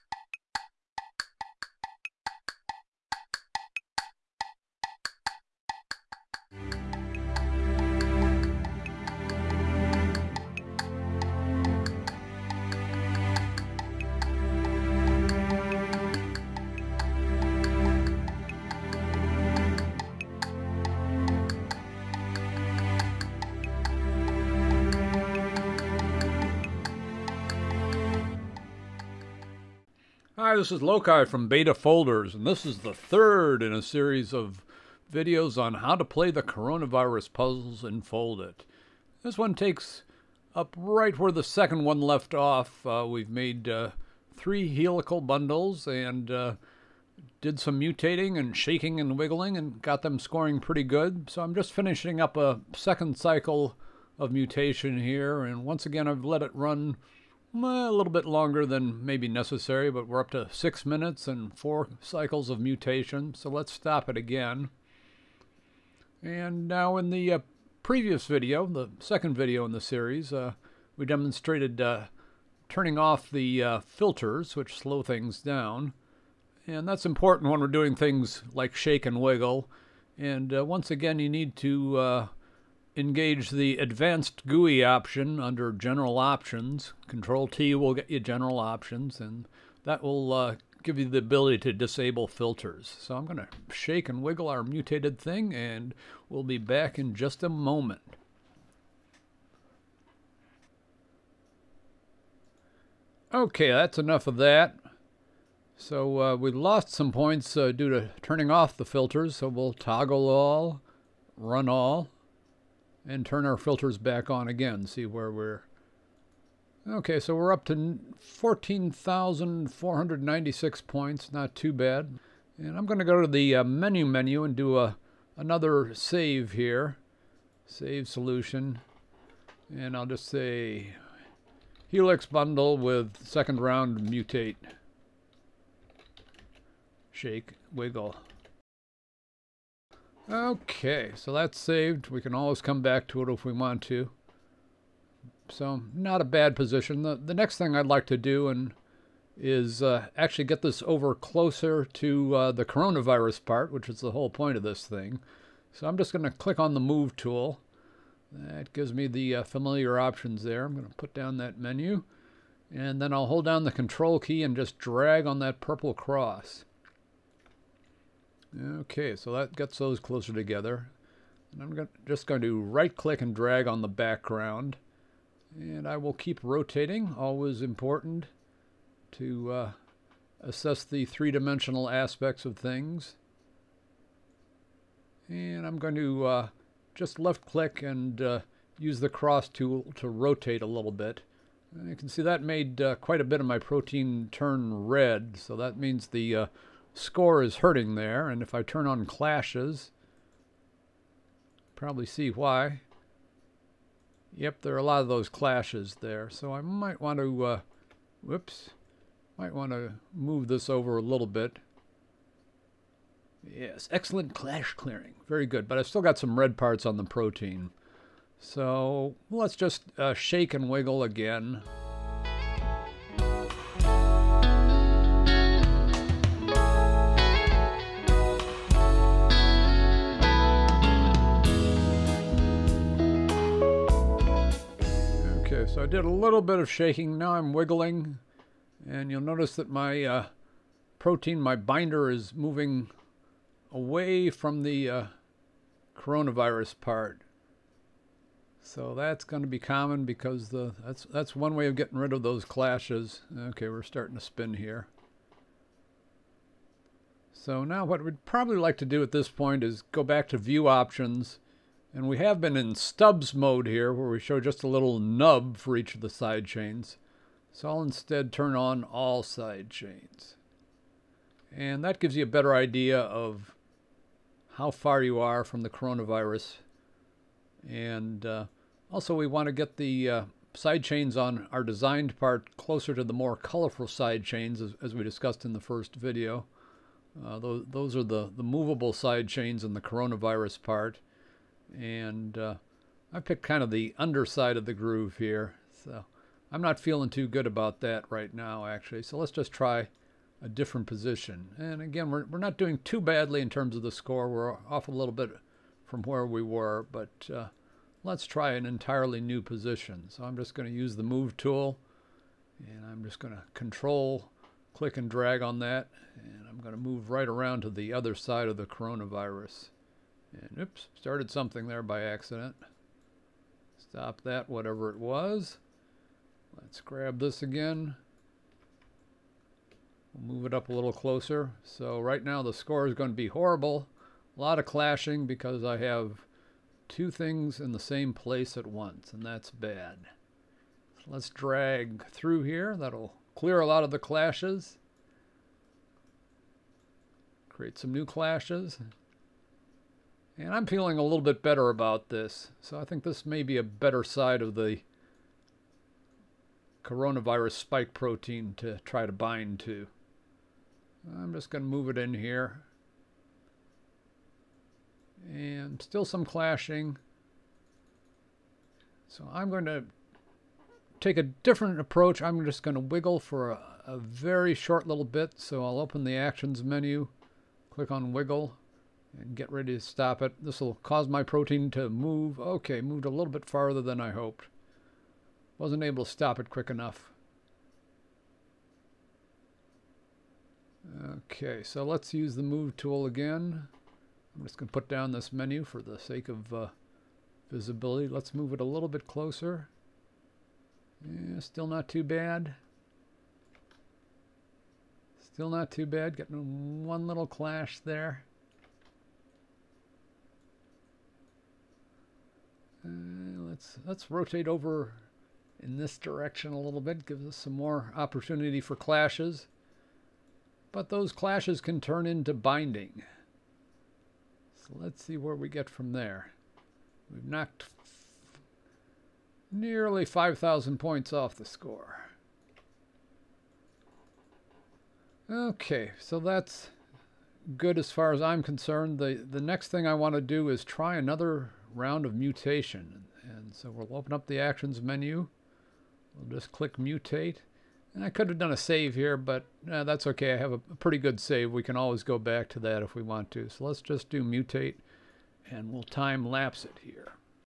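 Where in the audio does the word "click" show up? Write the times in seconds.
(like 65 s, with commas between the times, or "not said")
156 s, 172 s, 187 s, 314 s, 377 s, 446 s.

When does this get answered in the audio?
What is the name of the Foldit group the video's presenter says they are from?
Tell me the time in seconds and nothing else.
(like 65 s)
31 s.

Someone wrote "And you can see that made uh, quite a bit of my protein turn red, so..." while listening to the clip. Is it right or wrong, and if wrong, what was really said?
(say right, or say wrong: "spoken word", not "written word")
right.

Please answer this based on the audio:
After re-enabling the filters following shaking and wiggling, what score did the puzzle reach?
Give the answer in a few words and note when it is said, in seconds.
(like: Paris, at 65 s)
14,496, at 118 s.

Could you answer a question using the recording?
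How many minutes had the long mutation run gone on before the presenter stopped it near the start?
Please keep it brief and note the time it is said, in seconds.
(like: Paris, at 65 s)
6, at 60 s.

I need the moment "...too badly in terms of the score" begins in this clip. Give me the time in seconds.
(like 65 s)
302 s.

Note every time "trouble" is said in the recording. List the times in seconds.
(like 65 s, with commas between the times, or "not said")
not said.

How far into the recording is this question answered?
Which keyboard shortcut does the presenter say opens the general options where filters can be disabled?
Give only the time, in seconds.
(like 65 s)
87 s.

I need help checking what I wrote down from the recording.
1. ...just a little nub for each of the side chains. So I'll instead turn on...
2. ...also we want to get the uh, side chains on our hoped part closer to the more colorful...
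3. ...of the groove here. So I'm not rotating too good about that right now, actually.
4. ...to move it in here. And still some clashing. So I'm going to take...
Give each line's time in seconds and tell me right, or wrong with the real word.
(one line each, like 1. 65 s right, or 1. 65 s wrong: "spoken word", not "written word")
1. 264 s right
2. 278 s wrong: "designed", not "hoped"
3. 294 s wrong: "feeling", not "rotating"
4. 361 s right.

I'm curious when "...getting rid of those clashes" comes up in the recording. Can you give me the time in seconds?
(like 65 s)
251 s.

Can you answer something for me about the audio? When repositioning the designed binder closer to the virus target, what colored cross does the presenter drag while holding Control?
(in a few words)
Purple.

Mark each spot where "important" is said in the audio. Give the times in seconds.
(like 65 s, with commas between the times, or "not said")
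77 s, 177 s.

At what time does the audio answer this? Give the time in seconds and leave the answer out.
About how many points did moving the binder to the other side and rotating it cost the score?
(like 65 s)
430 s.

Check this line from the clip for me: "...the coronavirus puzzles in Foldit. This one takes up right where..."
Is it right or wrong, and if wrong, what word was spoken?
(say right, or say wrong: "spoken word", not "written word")
right.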